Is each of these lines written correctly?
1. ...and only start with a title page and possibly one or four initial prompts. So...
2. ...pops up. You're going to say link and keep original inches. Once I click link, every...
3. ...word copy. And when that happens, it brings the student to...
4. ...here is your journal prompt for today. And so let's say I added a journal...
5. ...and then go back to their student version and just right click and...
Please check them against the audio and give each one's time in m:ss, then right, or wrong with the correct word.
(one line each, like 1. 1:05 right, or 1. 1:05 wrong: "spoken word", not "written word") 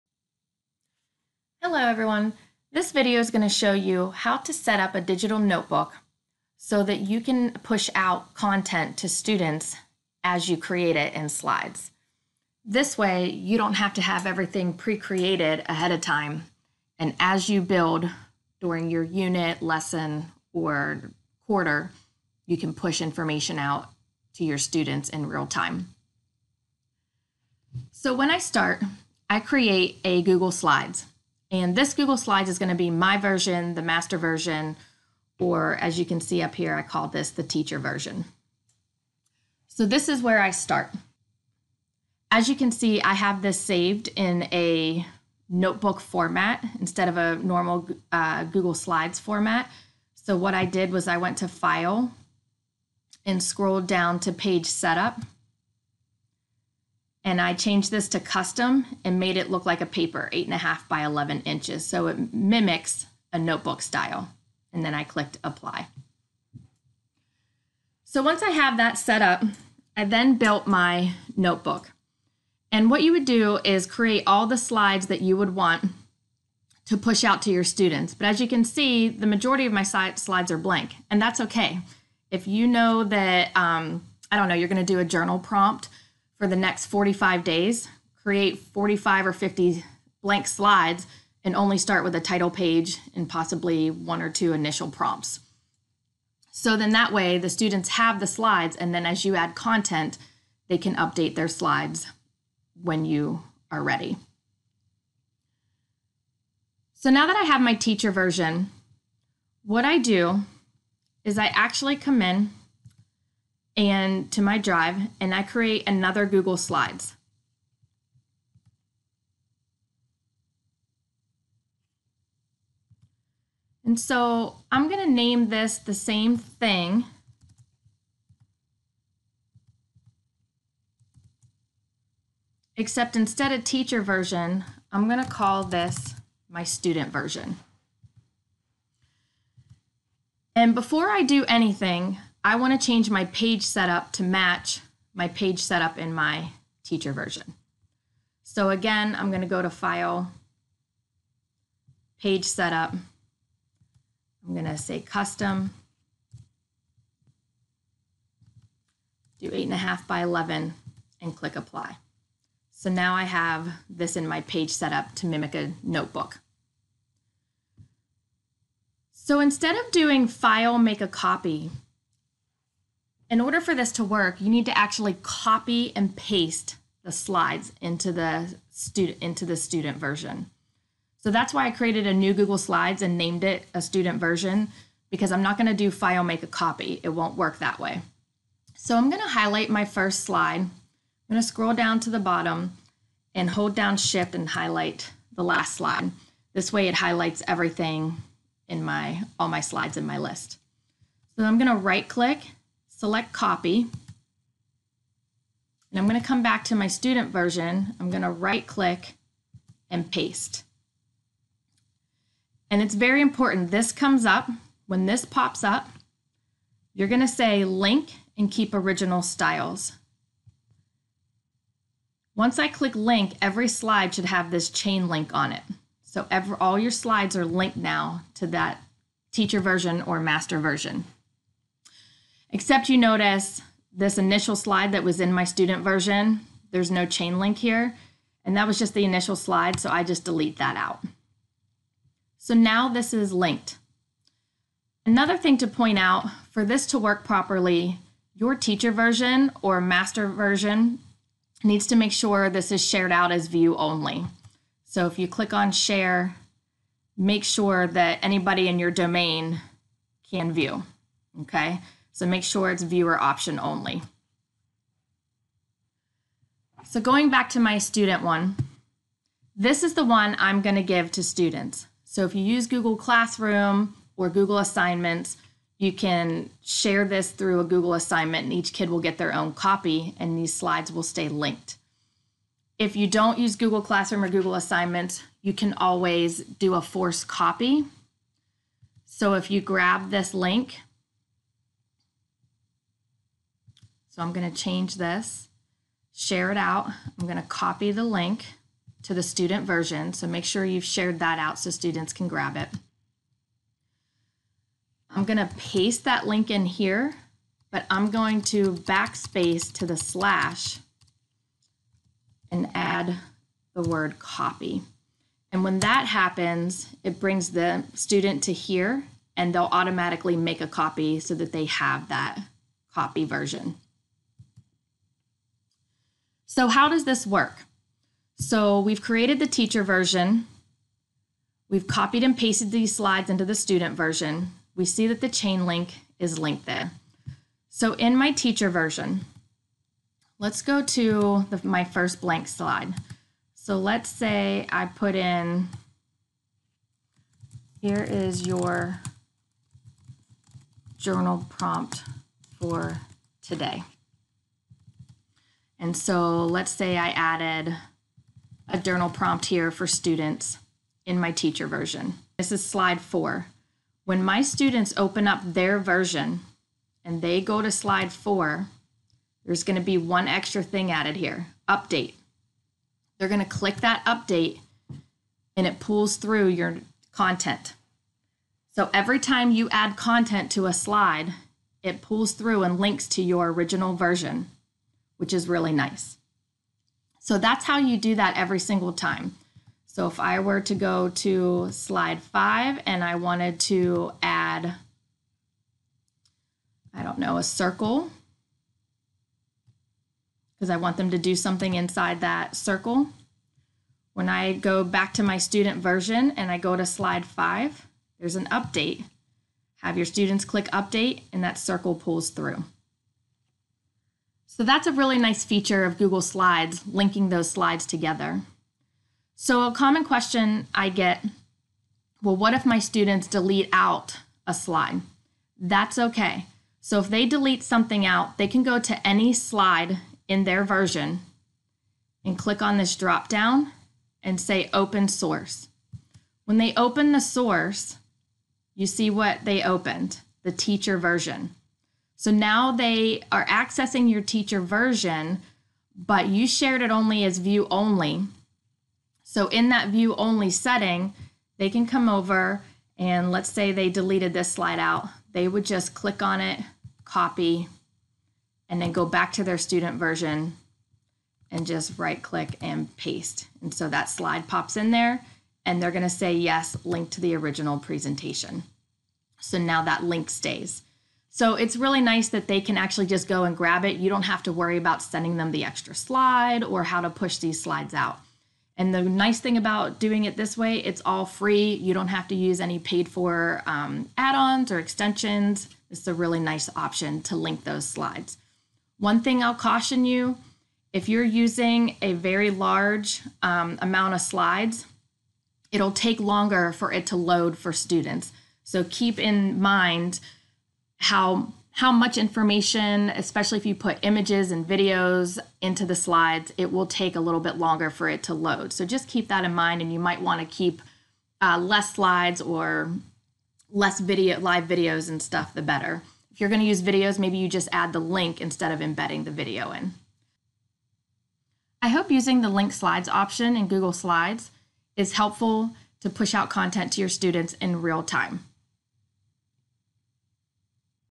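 1. 1:31 wrong: "two", not "four"
2. 3:35 wrong: "styles", not "inches"
3. 5:13 right
4. 5:47 right
5. 7:38 right.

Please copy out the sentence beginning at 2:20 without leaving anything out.
And before I do anything, I want to change my page setup to match my page setup in my teacher version.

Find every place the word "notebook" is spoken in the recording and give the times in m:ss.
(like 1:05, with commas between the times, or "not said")
0:05, 0:45, 1:03, 1:11, 2:45.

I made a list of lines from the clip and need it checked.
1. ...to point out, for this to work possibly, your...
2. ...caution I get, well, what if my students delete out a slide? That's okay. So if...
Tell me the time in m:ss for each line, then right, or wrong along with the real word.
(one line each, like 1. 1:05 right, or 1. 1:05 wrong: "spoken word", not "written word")
1. 4:05 wrong: "properly", not "possibly"
2. 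7:00 wrong: "question", not "caution".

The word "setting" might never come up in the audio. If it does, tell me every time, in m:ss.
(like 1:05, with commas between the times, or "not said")
7:30.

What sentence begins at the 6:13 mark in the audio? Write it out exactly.
They're going to click that update and it pulls through your content.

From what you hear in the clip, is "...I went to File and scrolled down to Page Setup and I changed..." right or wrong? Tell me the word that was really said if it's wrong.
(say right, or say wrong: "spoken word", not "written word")
right.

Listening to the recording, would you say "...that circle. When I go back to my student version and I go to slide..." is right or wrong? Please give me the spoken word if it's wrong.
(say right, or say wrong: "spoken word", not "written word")
right.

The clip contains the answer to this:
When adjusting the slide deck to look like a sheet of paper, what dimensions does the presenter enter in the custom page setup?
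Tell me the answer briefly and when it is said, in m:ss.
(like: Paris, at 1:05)
8.5 by 11, at 2:39.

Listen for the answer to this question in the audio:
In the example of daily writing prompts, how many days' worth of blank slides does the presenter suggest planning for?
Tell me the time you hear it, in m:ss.
1:26.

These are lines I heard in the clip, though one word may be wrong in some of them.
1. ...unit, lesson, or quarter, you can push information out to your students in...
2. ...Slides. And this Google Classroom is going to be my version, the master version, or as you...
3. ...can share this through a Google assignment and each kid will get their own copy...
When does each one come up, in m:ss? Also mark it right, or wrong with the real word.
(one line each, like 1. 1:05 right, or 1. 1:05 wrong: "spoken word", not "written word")
1. 0:19 right
2. 0:30 wrong: "Slides", not "Classroom"
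3. 4:35 right.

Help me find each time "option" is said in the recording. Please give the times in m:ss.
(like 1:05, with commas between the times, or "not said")
4:23, 8:06, 8:43.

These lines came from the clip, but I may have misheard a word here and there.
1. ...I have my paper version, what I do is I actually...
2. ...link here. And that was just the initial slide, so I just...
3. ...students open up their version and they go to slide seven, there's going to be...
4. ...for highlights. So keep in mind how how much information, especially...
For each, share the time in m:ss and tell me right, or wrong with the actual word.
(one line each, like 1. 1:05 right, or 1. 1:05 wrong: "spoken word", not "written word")
1. 1:47 wrong: "teacher", not "paper"
2. 3:57 right
3. 6:04 wrong: "four", not "seven"
4. 8:17 wrong: "students", not "highlights".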